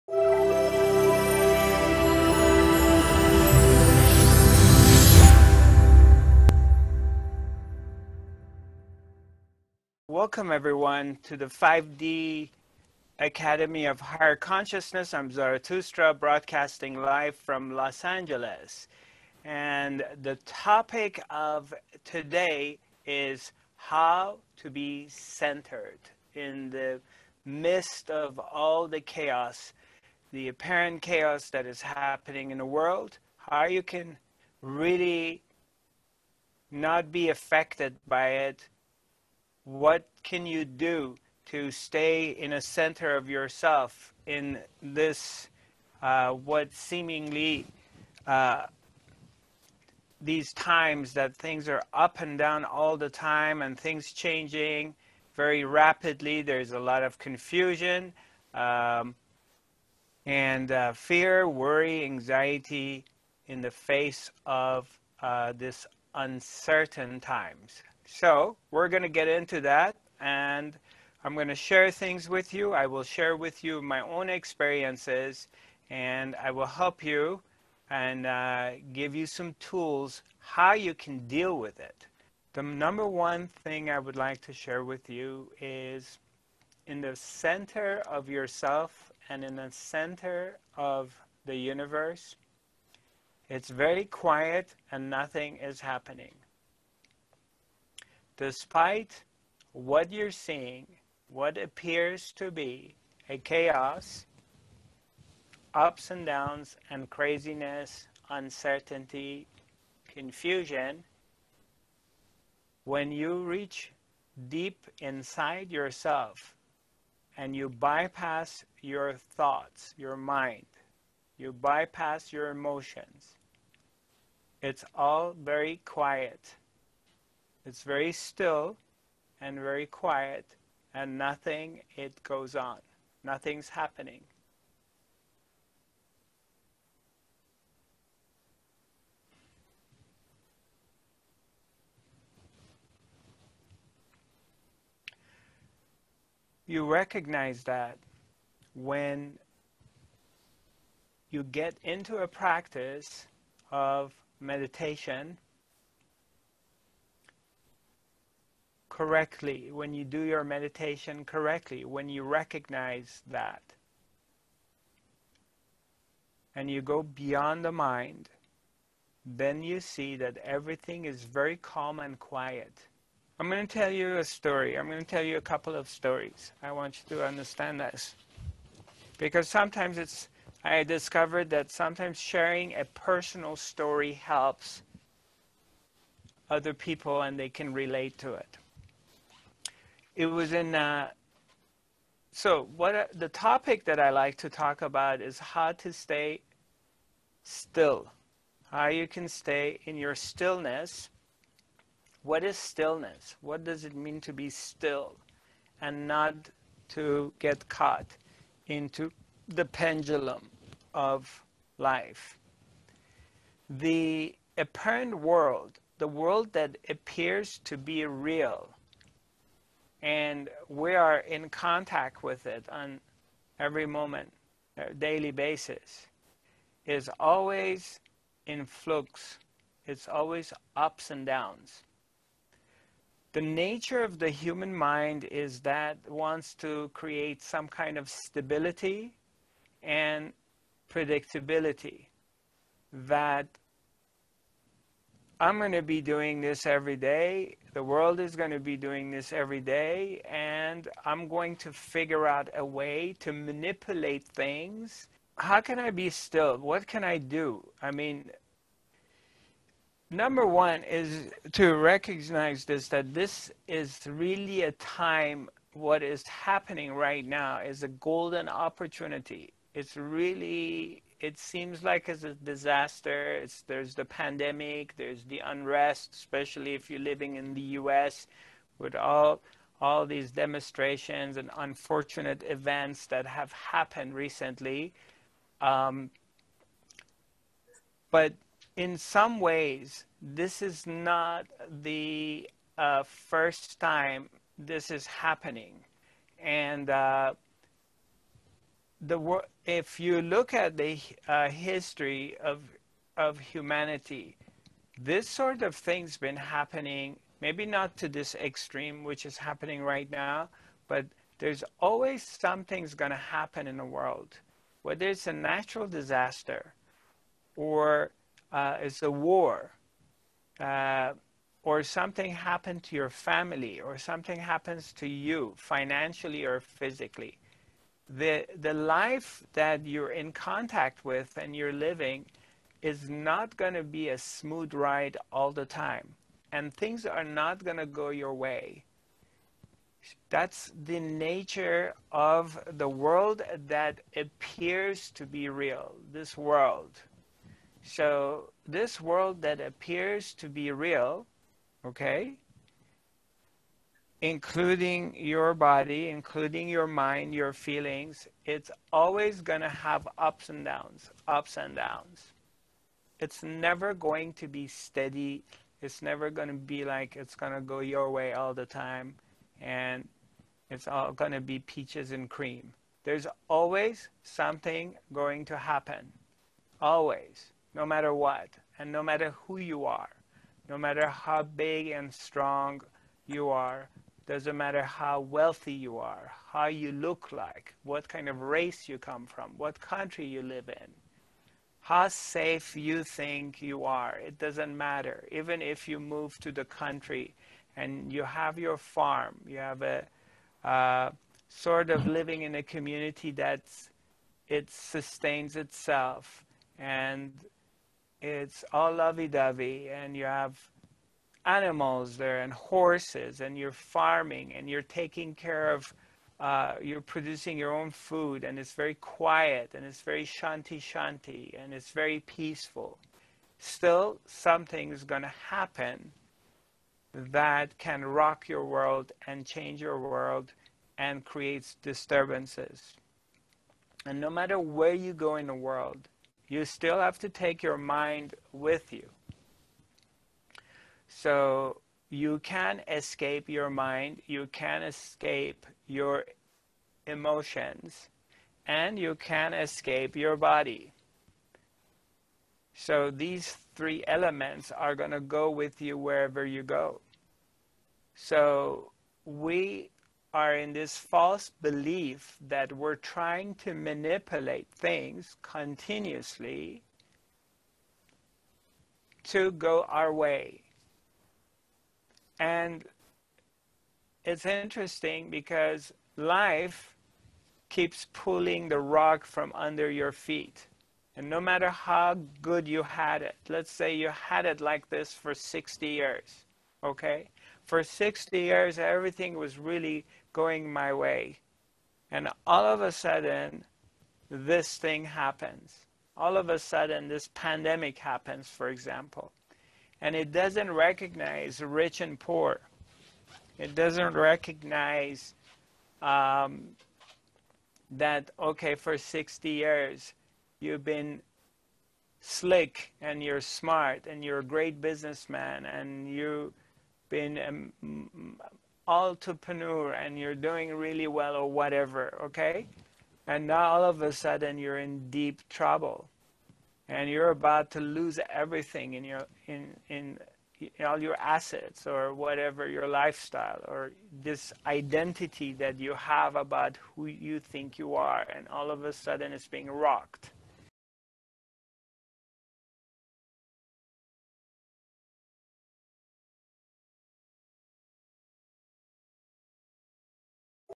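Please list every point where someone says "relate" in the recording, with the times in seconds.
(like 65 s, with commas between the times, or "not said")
187 s.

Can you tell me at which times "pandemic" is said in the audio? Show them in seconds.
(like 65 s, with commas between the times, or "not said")
274 s, 497 s.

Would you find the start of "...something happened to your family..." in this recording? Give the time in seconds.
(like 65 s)
321 s.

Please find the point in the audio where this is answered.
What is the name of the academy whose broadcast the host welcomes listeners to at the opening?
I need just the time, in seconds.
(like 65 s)
11 s.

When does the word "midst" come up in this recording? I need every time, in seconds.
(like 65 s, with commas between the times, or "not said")
27 s.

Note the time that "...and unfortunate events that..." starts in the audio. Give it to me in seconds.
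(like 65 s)
281 s.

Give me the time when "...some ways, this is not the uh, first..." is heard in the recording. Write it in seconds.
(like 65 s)
288 s.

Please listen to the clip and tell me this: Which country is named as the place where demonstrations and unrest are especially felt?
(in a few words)
U.S.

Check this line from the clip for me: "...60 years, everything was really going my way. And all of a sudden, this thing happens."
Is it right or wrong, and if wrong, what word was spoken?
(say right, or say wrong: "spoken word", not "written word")
right.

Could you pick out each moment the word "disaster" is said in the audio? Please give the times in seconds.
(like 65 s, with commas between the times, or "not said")
272 s, 315 s.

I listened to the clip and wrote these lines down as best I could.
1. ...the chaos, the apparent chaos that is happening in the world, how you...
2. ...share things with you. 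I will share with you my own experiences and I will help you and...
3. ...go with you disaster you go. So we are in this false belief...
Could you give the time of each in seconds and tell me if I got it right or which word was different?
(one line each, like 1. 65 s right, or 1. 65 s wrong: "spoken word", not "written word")
1. 28 s right
2. 71 s right
3. 455 s wrong: "wherever", not "disaster".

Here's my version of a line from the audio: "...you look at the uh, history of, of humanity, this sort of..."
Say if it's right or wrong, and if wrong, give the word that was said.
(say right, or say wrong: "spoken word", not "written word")
right.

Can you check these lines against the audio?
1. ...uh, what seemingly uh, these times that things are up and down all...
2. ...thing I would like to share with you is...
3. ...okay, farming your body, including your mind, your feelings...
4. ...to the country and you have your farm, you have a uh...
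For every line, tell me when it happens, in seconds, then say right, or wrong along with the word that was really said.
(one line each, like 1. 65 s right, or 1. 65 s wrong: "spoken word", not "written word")
1. 46 s right
2. 83 s right
3. 351 s wrong: "including", not "farming"
4. 396 s right.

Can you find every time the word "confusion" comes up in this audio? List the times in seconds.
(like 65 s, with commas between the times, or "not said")
57 s, 110 s.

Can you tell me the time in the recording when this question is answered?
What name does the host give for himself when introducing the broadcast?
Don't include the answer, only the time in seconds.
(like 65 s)
15 s.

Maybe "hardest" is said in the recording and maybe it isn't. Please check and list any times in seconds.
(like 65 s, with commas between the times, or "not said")
not said.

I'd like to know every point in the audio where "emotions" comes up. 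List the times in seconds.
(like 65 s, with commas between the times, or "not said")
122 s, 447 s.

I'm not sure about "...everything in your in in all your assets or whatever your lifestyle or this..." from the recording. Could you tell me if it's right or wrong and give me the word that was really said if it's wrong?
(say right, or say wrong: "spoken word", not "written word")
right.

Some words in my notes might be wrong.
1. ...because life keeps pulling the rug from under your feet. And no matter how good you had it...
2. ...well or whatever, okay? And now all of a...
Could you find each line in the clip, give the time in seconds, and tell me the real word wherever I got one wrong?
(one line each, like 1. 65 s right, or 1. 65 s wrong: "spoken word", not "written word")
1. 475 s right
2. 521 s right.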